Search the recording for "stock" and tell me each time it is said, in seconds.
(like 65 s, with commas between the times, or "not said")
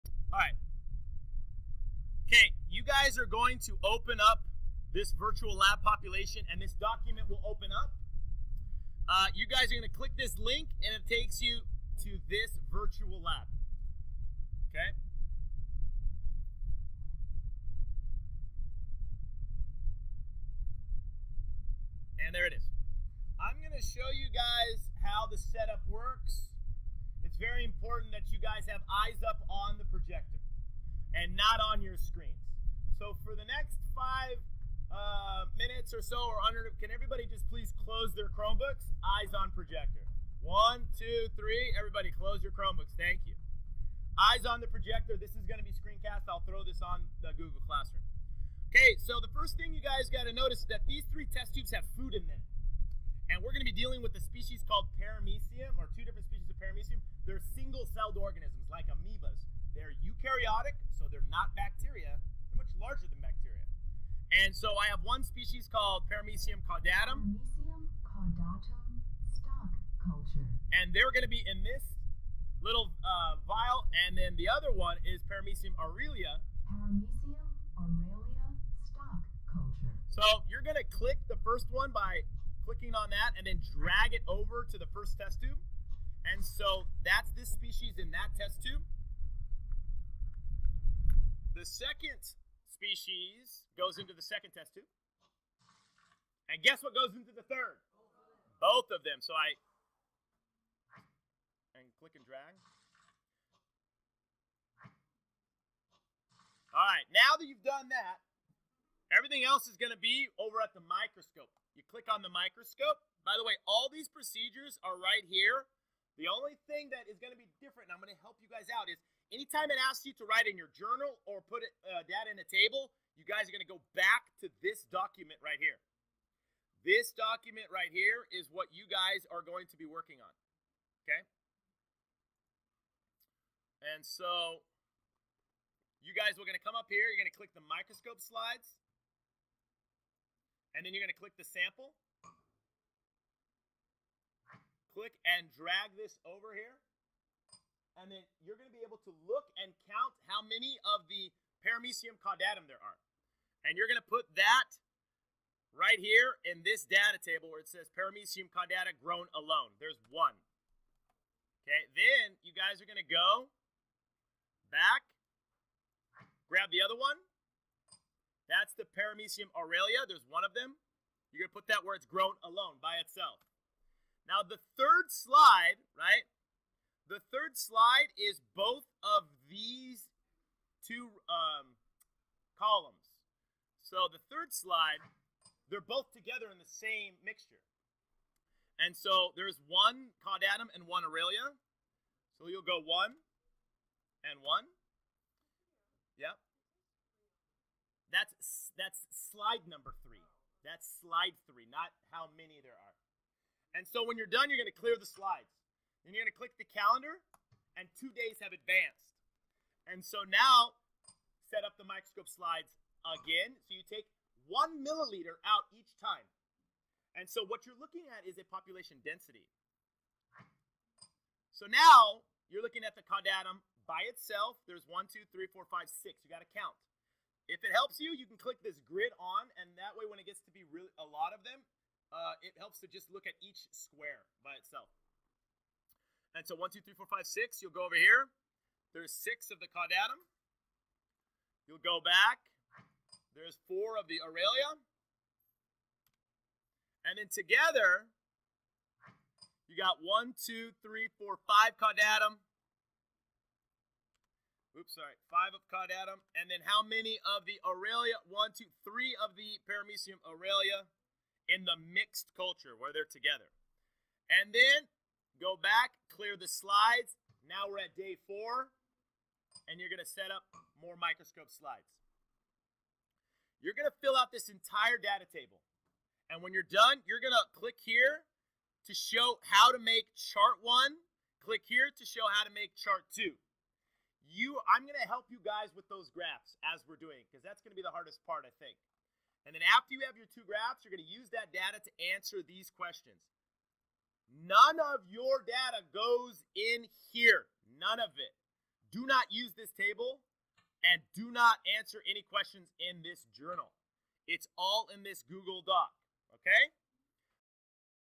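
69 s, 78 s.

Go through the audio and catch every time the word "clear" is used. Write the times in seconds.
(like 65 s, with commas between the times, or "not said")
204 s, 266 s.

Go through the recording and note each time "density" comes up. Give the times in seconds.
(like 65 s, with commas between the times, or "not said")
219 s.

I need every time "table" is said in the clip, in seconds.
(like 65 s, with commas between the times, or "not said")
122 s, 157 s, 275 s, 299 s.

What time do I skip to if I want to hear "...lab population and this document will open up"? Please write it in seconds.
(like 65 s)
5 s.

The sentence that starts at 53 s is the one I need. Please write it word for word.
And we're going to be dealing with a species called Paramecium, or two different species of Paramecium.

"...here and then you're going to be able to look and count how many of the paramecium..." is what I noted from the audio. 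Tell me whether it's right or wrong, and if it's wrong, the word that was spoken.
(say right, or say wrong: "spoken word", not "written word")
right.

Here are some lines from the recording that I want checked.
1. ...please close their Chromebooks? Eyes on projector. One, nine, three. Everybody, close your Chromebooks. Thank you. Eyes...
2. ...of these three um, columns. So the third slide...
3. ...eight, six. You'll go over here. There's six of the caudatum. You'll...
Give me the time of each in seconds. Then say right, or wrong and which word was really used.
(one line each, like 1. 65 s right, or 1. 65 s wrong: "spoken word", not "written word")
1. 37 s wrong: "two", not "nine"
2. 179 s wrong: "two", not "three"
3. 237 s wrong: "five", not "eight".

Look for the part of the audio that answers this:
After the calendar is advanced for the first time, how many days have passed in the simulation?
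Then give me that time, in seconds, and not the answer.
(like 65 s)
207 s.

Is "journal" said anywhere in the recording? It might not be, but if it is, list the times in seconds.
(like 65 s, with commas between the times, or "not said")
120 s, 303 s.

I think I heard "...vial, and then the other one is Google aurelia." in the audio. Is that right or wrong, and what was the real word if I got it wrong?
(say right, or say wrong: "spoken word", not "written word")
wrong: "Paramecium", not "Google".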